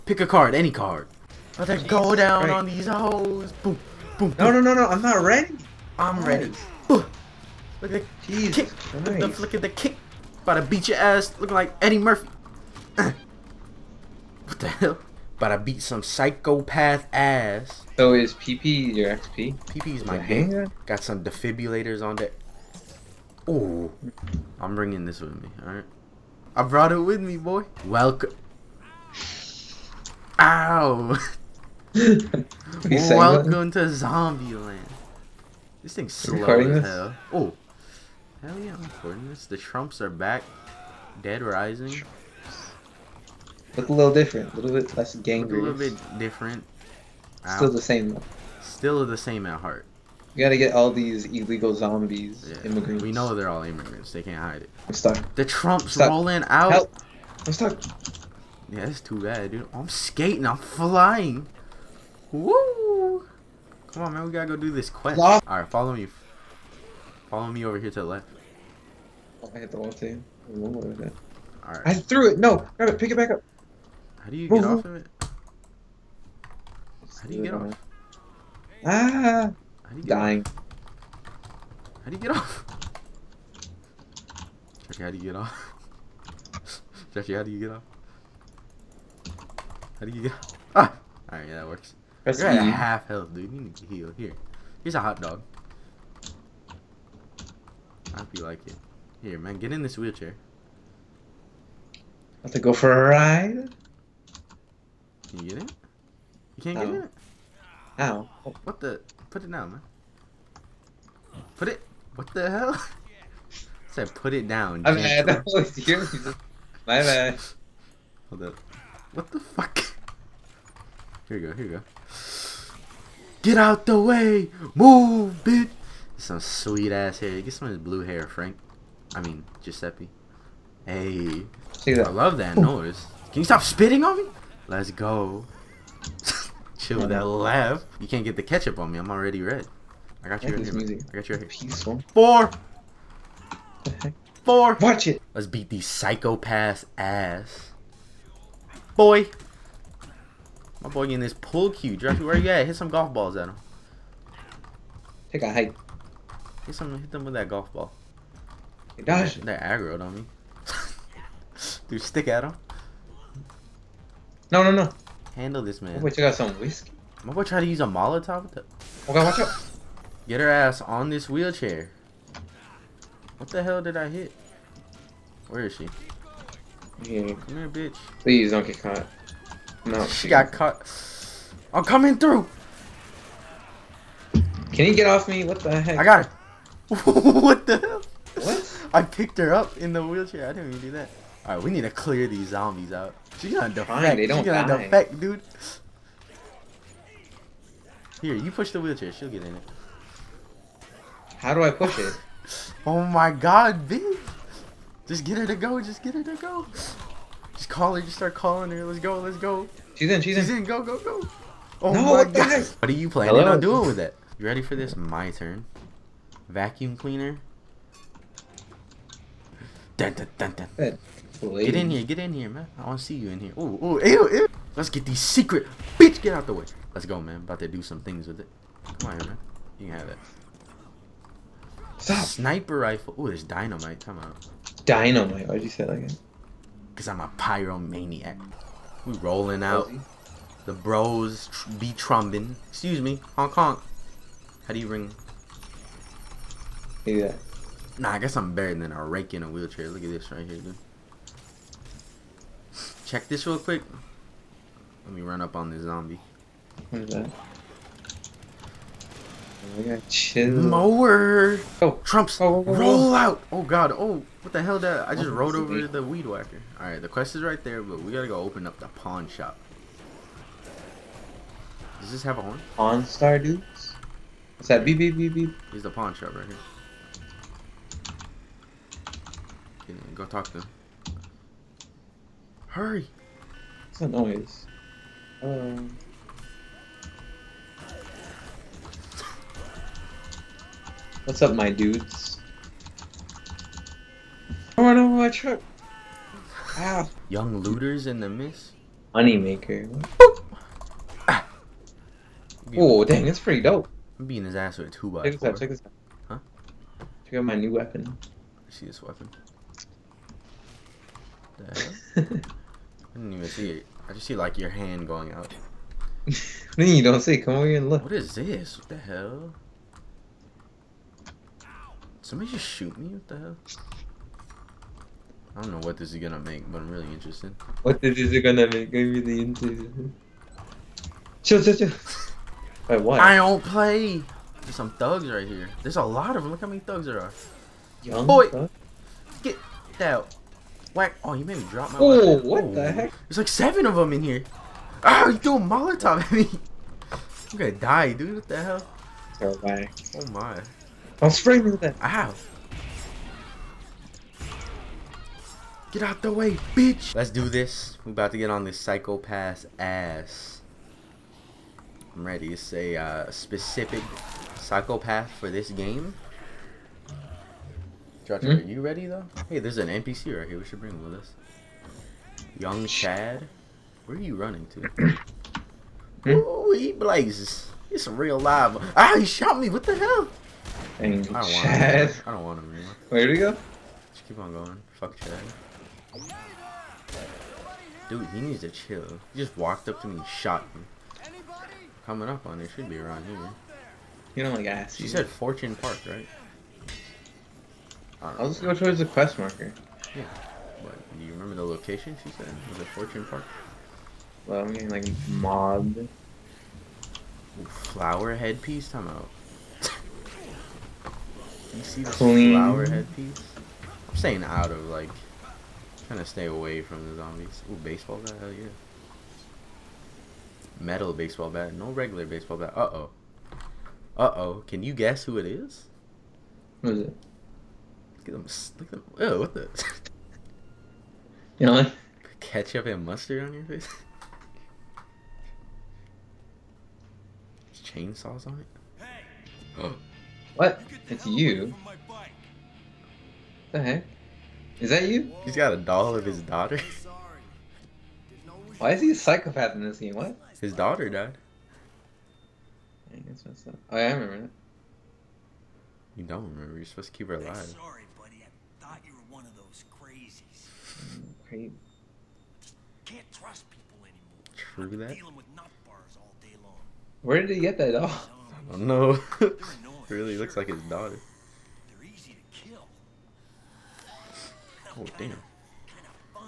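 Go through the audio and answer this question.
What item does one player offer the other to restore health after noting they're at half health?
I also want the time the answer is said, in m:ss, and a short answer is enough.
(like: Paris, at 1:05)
Hot dog, at 1:34.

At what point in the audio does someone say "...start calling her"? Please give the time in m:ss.
3:28.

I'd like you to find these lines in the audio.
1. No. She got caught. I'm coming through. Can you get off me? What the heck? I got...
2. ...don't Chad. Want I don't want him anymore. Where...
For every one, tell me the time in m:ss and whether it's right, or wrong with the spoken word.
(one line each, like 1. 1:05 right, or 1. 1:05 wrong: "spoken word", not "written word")
1. 2:59 right
2. 6:21 right.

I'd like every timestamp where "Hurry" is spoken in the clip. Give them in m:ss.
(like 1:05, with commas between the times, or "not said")
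4:42.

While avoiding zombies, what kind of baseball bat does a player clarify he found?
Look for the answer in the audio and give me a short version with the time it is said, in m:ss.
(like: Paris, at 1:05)
Regular baseball bat, at 7:01.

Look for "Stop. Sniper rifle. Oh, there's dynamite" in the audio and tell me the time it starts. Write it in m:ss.
3:51.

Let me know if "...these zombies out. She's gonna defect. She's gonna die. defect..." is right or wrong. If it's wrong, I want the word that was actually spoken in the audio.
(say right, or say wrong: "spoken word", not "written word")
right.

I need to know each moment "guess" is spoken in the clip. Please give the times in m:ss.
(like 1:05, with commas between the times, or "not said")
4:08, 7:04.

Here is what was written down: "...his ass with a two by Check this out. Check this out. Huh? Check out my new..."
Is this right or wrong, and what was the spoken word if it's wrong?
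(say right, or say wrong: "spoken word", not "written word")
right.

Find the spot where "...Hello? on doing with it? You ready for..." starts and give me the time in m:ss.
3:33.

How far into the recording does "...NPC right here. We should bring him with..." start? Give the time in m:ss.
6:09.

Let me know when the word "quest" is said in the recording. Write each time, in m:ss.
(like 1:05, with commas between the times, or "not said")
1:04, 4:27, 6:39.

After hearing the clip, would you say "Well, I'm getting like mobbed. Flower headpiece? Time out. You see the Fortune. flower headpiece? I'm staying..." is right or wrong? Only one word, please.
wrong.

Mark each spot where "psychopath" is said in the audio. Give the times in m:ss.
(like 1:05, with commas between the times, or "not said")
0:16, 2:25, 5:58, 6:04, 7:29.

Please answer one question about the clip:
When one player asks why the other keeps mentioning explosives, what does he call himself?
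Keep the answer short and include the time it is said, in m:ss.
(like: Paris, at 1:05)
Pyromaniac, at 3:57.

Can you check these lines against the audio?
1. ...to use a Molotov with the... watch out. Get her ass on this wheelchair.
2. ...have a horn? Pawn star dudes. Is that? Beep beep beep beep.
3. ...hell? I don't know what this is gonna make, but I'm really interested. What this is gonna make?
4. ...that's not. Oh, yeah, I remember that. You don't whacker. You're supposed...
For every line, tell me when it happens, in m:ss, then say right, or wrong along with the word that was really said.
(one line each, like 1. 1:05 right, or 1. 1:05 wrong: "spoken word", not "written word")
1. 2:47 right
2. 4:32 right
3. 5:23 right
4. 7:33 wrong: "remember", not "whacker".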